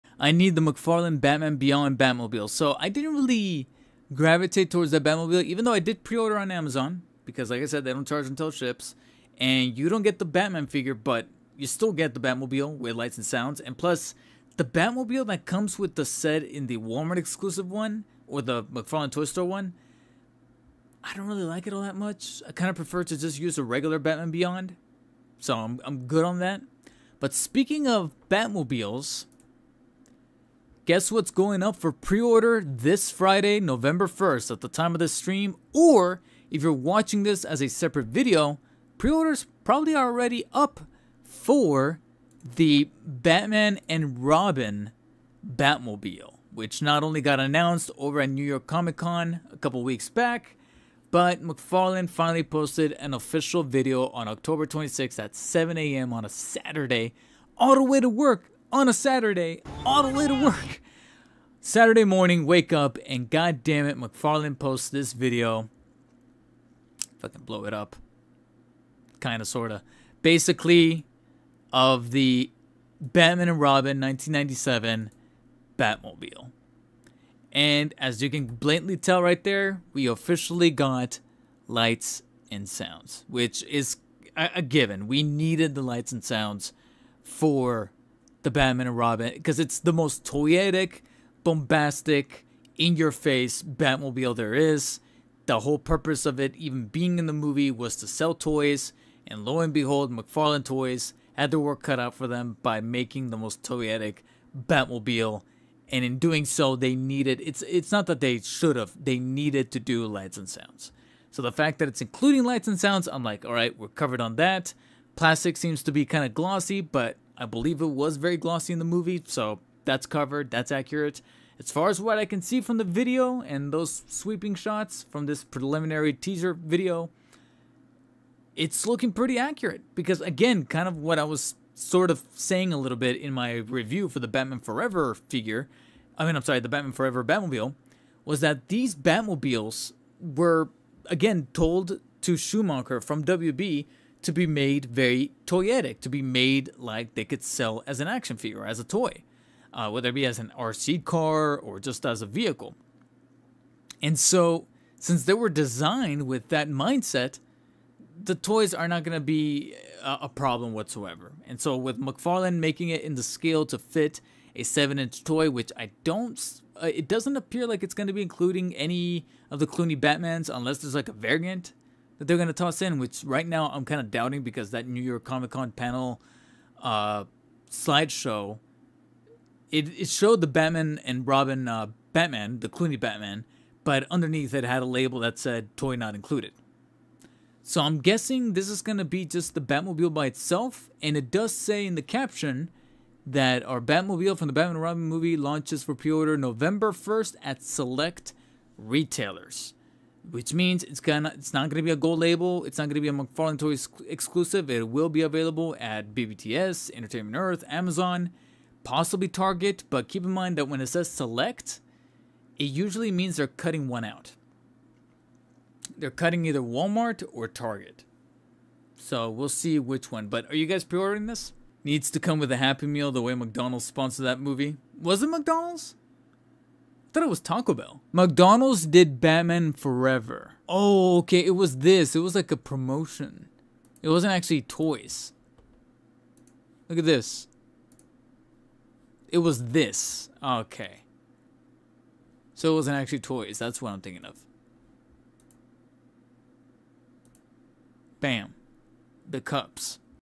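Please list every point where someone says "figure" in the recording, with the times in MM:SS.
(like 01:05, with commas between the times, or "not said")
00:10, 02:15, 02:28.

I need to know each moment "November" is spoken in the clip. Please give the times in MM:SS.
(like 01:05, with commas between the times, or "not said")
00:33, 03:16.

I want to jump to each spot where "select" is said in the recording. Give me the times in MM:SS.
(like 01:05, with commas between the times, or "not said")
03:17, 03:31.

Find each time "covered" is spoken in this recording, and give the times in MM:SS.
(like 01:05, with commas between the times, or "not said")
01:53, 02:00.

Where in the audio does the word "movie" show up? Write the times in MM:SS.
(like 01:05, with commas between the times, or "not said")
01:37, 01:58, 03:15, 03:44.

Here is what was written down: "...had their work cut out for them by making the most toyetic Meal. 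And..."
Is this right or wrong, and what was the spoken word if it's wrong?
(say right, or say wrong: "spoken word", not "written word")
wrong: "Batmobile", not "Meal".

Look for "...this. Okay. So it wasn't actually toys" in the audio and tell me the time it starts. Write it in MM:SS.
03:59.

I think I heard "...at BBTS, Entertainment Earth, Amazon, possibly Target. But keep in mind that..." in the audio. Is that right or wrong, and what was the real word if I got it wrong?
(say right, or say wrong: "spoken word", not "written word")
right.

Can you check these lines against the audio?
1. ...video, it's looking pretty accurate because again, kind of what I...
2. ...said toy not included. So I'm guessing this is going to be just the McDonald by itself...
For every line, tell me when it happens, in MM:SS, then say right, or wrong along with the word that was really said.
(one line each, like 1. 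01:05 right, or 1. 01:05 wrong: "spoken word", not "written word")
1. 02:06 right
2. 03:05 wrong: "Batmobile", not "McDonald".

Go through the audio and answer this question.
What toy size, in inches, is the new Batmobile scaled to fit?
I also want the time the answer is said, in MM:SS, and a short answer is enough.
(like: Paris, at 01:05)
7 inch, at 02:44.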